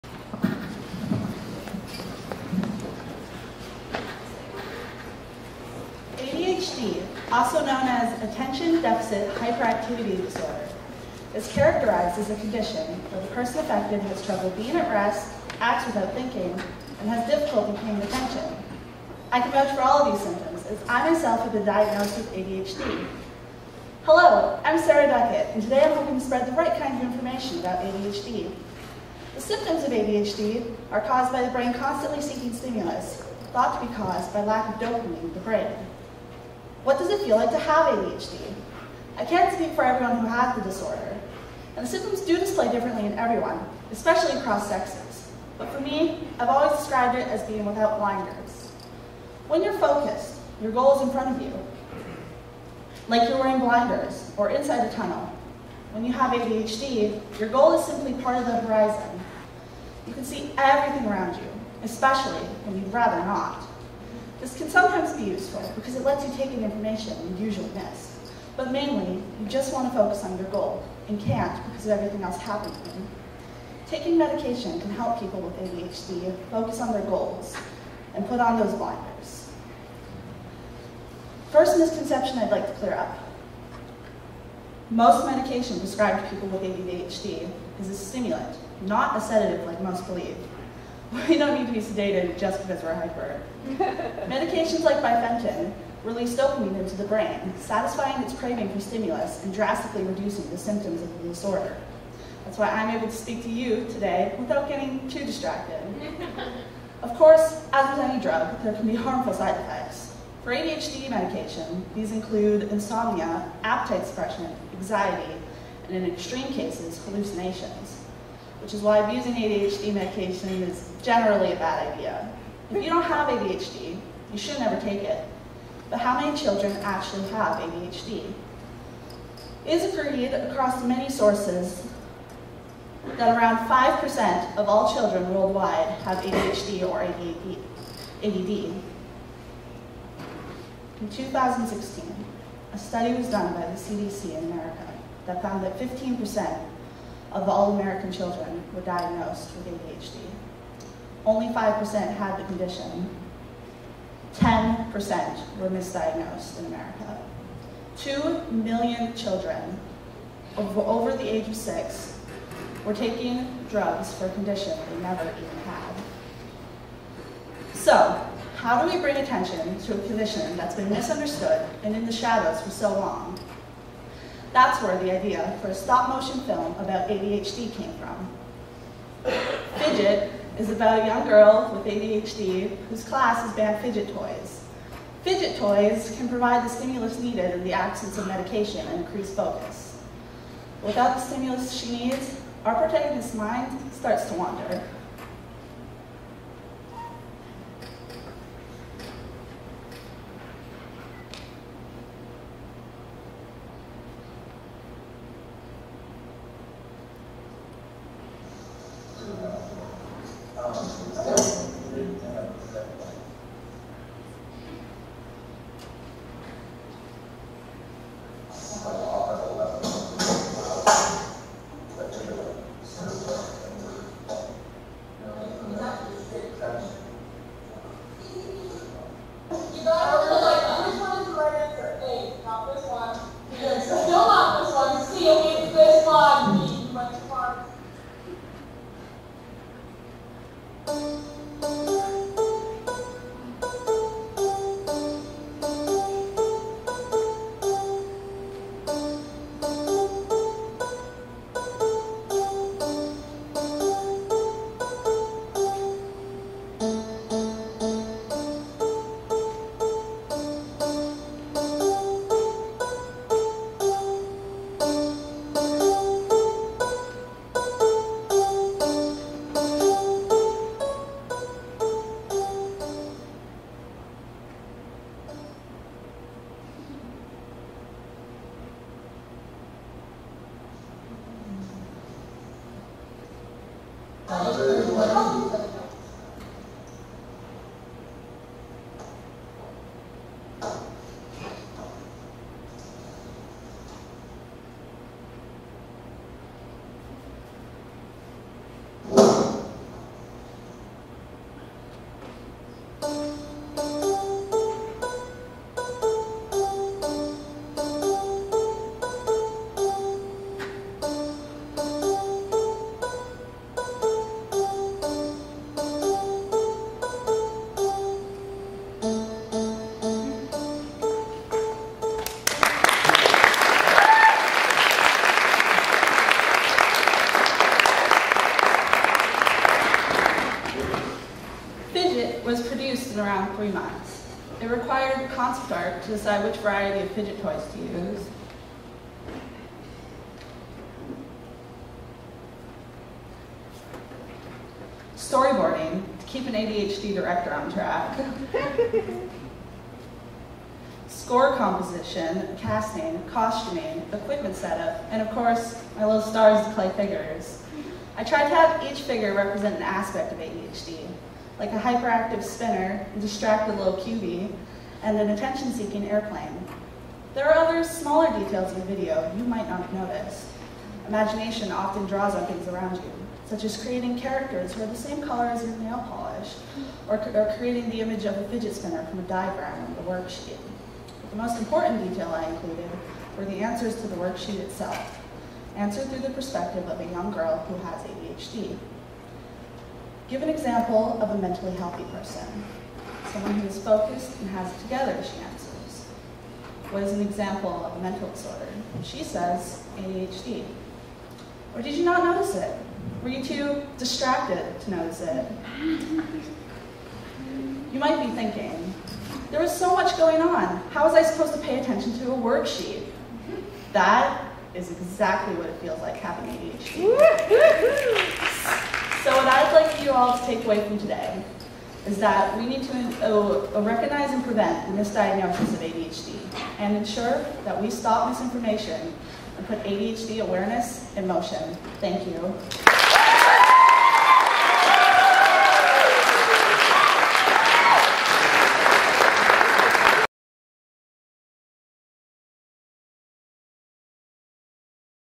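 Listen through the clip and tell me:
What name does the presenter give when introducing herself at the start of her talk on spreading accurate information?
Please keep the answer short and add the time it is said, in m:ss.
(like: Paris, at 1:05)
Sarah Duckett, at 0:24.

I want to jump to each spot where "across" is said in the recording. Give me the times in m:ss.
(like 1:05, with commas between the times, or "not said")
0:44, 2:10.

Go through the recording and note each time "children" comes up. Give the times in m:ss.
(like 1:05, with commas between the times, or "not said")
2:06, 2:14, 2:28, 2:39.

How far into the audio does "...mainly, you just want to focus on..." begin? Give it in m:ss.
1:08.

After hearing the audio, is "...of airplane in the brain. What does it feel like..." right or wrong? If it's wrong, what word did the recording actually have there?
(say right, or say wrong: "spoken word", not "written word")
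wrong: "dopamine", not "airplane".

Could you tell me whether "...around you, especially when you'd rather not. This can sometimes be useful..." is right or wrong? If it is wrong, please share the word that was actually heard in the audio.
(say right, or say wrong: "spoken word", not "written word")
right.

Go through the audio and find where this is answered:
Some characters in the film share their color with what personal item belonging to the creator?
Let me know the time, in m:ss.
6:15.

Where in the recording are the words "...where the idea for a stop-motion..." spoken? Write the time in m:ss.
2:54.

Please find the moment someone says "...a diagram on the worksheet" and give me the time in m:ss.
6:19.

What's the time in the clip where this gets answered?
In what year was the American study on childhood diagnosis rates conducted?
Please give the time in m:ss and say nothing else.
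2:21.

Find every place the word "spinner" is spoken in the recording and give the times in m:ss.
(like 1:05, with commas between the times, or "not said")
6:02, 6:18.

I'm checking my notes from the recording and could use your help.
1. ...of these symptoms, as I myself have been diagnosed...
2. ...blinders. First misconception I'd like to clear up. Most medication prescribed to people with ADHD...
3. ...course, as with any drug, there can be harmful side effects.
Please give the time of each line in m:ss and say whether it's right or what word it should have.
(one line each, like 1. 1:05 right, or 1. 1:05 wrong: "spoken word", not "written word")
1. 0:20 right
2. 1:18 right
3. 1:47 right.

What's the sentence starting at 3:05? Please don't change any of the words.
Fidget toys can provide the stimulus needed in the absence of medication and increase focus.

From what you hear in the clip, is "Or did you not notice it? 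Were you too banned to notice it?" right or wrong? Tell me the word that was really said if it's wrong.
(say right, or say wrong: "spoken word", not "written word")
wrong: "distracted", not "banned".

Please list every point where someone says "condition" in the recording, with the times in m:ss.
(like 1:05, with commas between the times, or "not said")
0:12, 2:32, 2:44, 2:50.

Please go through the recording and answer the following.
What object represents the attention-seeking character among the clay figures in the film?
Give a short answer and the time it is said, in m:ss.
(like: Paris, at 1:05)
Airplane, at 6:06.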